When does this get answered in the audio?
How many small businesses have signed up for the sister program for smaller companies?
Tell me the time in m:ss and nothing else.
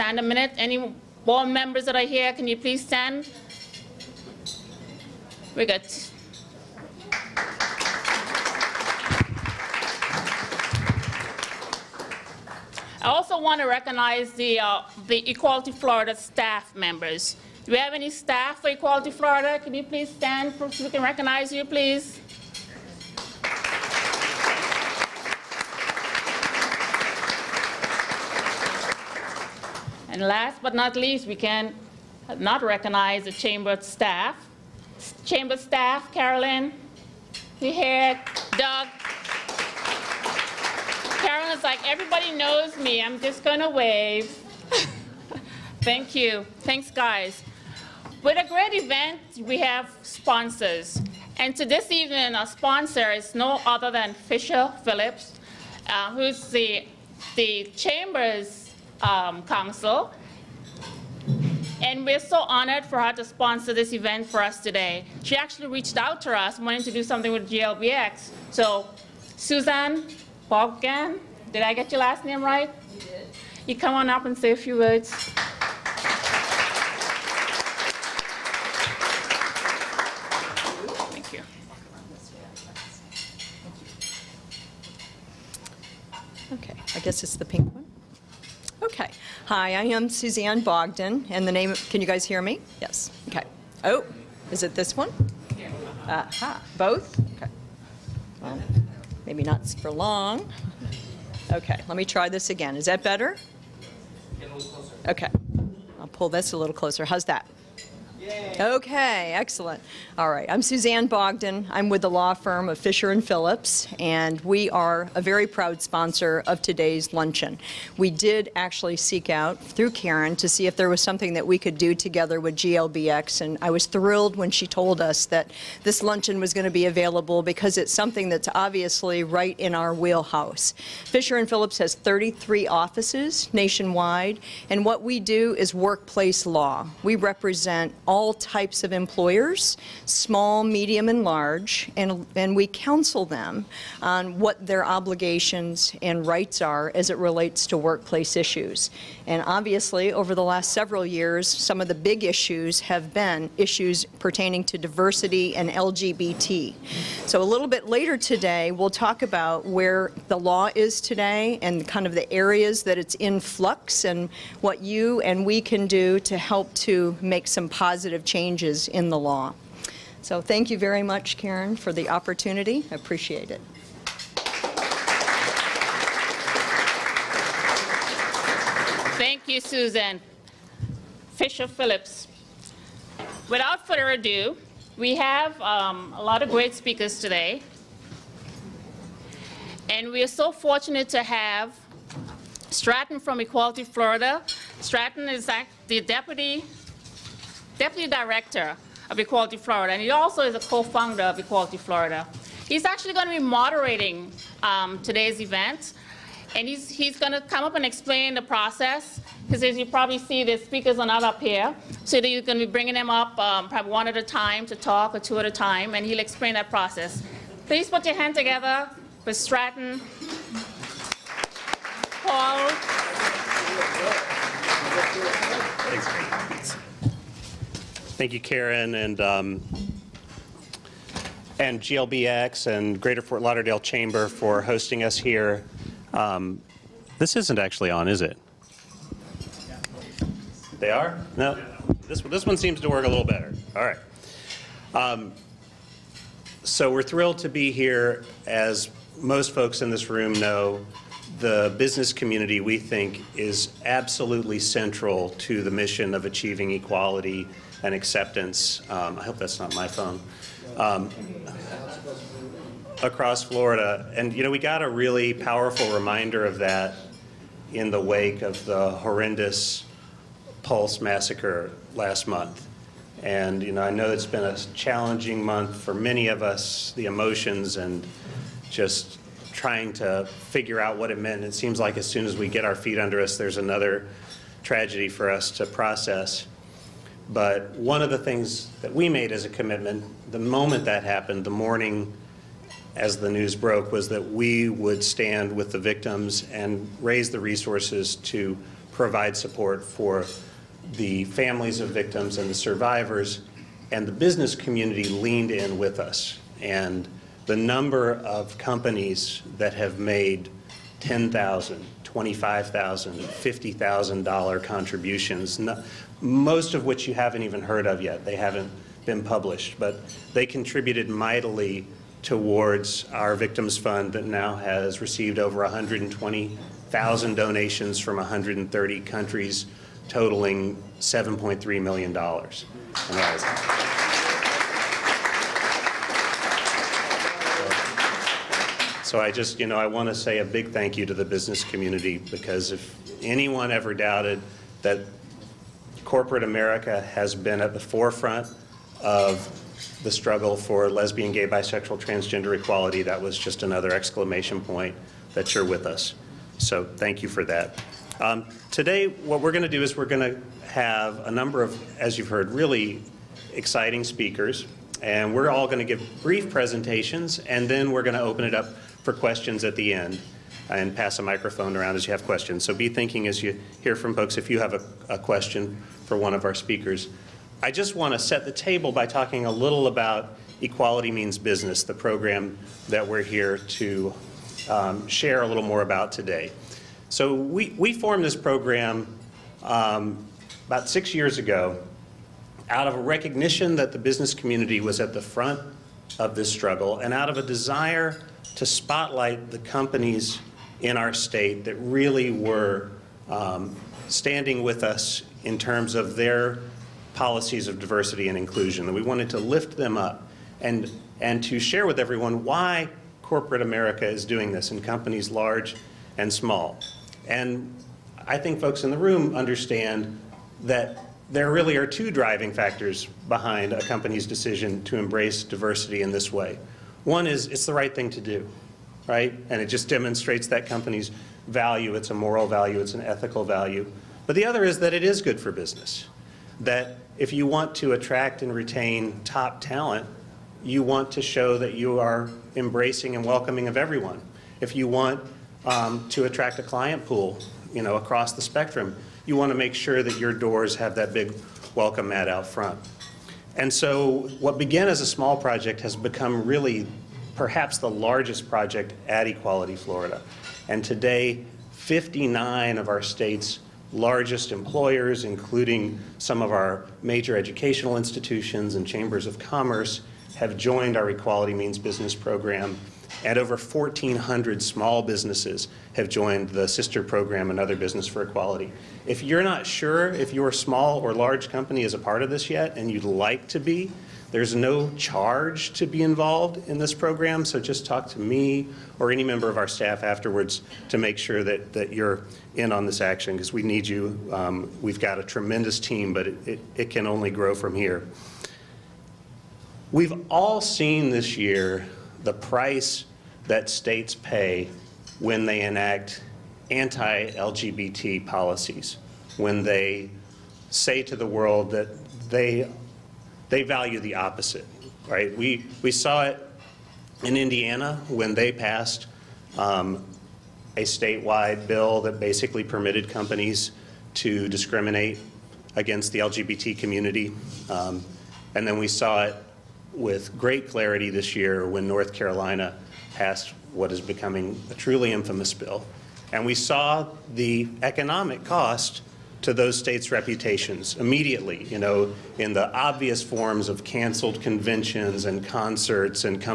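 7:53.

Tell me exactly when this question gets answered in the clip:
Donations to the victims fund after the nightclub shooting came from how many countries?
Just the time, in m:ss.
5:28.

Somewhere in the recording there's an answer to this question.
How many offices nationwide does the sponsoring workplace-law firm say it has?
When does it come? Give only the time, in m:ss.
2:11.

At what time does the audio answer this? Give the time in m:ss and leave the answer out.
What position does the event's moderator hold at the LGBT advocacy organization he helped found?
3:16.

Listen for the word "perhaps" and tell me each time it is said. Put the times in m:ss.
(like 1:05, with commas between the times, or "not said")
7:37.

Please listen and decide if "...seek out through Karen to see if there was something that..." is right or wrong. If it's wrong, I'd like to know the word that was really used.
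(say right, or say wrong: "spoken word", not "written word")
right.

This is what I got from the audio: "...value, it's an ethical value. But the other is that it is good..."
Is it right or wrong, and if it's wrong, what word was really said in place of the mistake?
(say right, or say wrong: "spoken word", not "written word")
right.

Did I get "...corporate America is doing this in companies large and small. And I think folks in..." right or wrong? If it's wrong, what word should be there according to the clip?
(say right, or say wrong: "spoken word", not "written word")
right.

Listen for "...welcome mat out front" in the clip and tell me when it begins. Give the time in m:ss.
7:31.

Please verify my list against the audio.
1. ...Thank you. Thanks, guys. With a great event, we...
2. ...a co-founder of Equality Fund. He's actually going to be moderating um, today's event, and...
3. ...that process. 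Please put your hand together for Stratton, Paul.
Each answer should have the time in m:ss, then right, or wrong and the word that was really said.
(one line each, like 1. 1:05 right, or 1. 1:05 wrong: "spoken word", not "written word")
1. 0:45 right
2. 3:20 wrong: "Florida", not "Fund"
3. 3:36 right.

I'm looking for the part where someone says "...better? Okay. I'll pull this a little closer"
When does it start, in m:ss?
1:43.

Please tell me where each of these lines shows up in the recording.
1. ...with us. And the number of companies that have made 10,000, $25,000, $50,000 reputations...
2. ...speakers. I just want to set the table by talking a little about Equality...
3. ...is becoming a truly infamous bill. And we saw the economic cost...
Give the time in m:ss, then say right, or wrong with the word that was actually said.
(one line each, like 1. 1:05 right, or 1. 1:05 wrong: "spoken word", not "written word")
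1. 5:05 wrong: "contributions", not "reputations"
2. 6:16 right
3. 8:53 right.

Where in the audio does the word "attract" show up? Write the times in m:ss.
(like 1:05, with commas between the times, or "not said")
7:17, 7:26.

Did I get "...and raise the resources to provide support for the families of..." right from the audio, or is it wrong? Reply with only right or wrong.
right.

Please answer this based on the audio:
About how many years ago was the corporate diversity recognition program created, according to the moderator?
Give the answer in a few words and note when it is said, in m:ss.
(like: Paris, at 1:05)
6 years, at 6:30.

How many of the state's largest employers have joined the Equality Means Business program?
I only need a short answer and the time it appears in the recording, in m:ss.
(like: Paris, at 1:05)
59, at 7:41.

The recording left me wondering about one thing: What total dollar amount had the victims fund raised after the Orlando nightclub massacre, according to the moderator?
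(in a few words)
$7.3 million.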